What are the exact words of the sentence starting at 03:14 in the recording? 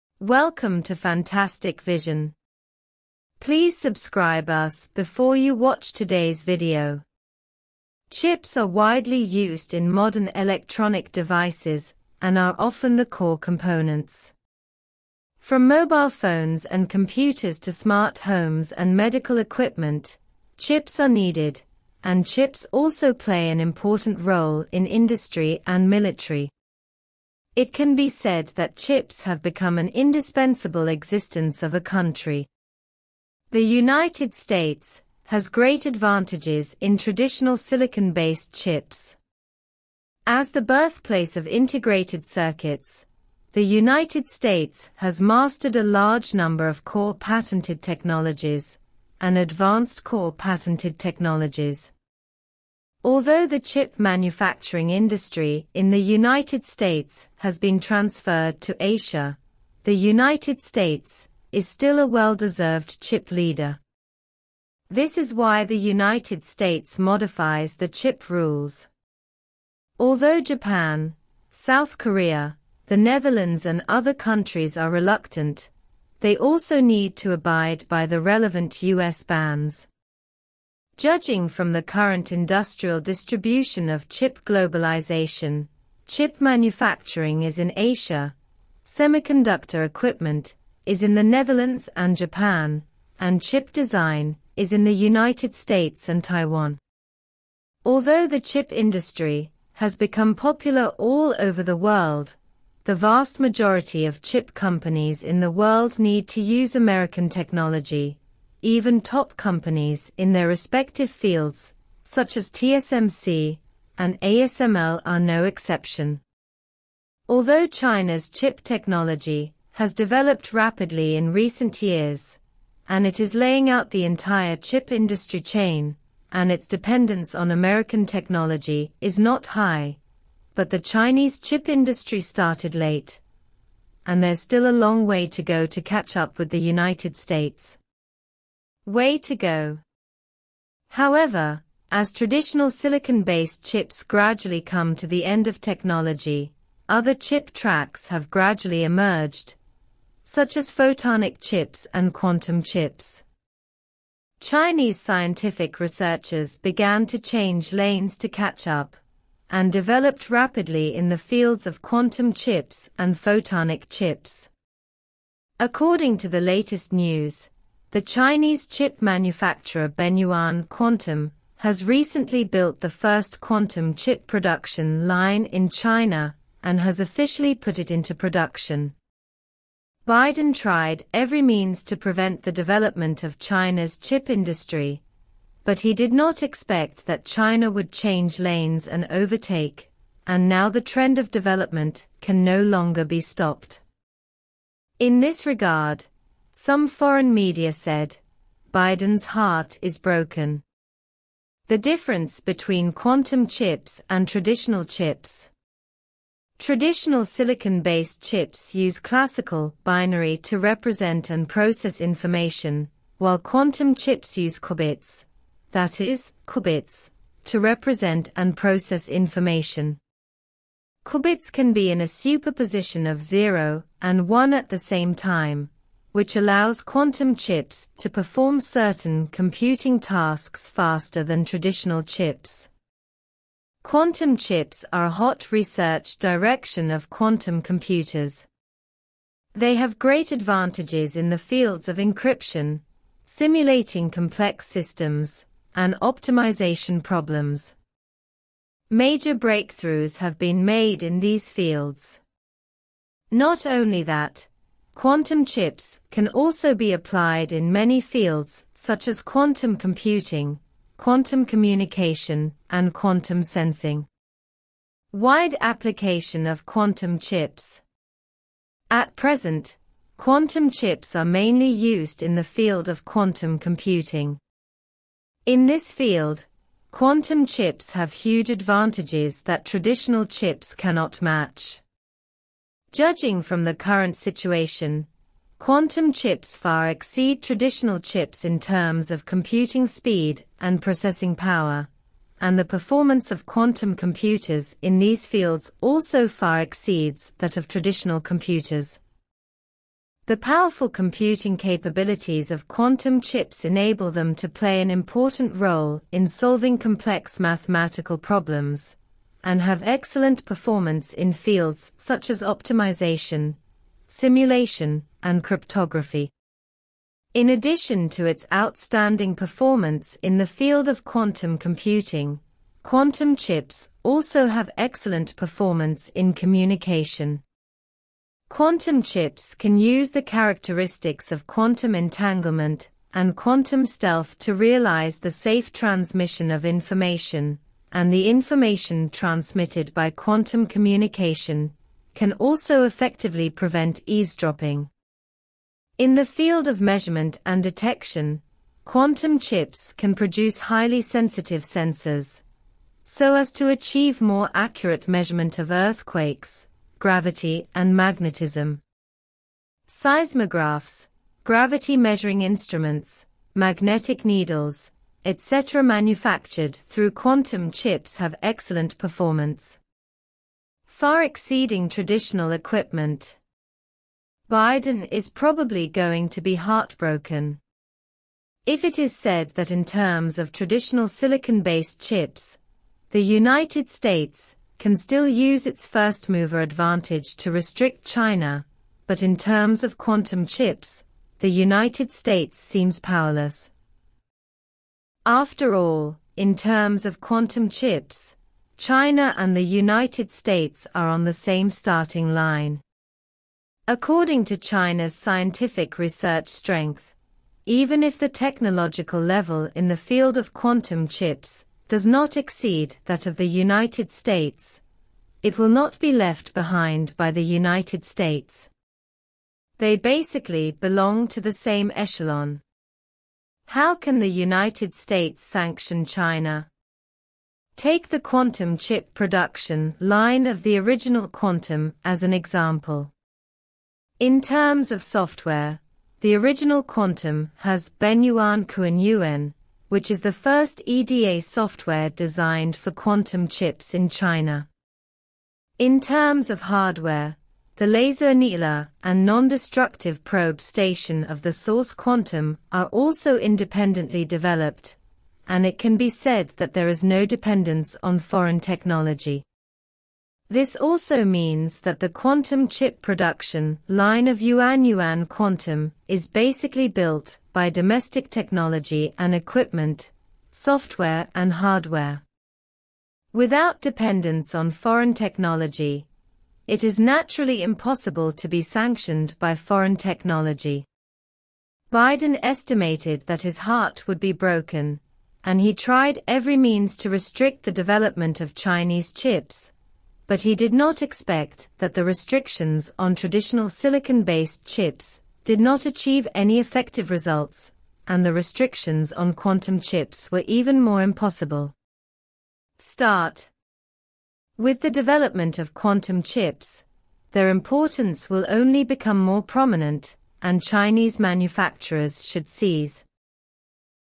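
In this regard, some foreign media said, Biden's heart is broken.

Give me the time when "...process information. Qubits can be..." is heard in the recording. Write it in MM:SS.
03:38.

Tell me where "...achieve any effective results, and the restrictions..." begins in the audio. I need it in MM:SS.
08:15.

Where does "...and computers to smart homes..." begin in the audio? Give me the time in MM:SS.
00:16.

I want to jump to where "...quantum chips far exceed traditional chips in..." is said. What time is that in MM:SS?
04:45.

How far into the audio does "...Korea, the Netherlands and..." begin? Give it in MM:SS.
01:11.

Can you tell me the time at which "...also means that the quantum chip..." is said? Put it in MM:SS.
07:40.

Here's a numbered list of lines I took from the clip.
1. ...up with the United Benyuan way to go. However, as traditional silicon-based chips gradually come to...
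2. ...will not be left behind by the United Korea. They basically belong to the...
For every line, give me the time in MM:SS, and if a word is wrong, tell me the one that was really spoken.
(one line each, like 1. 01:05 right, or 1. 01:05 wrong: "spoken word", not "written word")
1. 02:16 wrong: "States", not "Benyuan"
2. 06:55 wrong: "States", not "Korea".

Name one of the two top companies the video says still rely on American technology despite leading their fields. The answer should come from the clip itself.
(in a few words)
TSMC.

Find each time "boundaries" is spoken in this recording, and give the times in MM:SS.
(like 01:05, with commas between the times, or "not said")
not said.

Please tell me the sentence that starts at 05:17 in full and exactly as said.
In addition to its outstanding performance in the field of quantum computing, quantum chips also have excellent performance in communication.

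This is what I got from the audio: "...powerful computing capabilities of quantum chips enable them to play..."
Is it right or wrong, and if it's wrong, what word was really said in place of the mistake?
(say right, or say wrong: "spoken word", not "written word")
right.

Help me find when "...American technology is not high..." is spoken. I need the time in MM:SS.
02:07.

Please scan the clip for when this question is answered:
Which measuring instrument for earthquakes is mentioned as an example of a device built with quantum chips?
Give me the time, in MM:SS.
05:59.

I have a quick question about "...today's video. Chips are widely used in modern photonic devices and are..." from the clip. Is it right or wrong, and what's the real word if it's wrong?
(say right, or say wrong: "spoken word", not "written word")
wrong: "electronic", not "photonic".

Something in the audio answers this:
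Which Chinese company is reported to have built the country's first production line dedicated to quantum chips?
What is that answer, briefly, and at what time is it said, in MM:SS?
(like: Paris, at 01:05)
Benyuan Quantum, at 02:49.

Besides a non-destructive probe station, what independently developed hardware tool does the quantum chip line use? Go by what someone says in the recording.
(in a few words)
laser annealer.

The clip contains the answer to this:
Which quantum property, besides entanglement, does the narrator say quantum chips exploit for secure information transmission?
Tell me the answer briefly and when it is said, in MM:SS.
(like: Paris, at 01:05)
quantum stealth, at 05:33.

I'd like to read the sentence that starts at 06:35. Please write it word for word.
After all, in terms of quantum chips, China and the United States are on the same starting line.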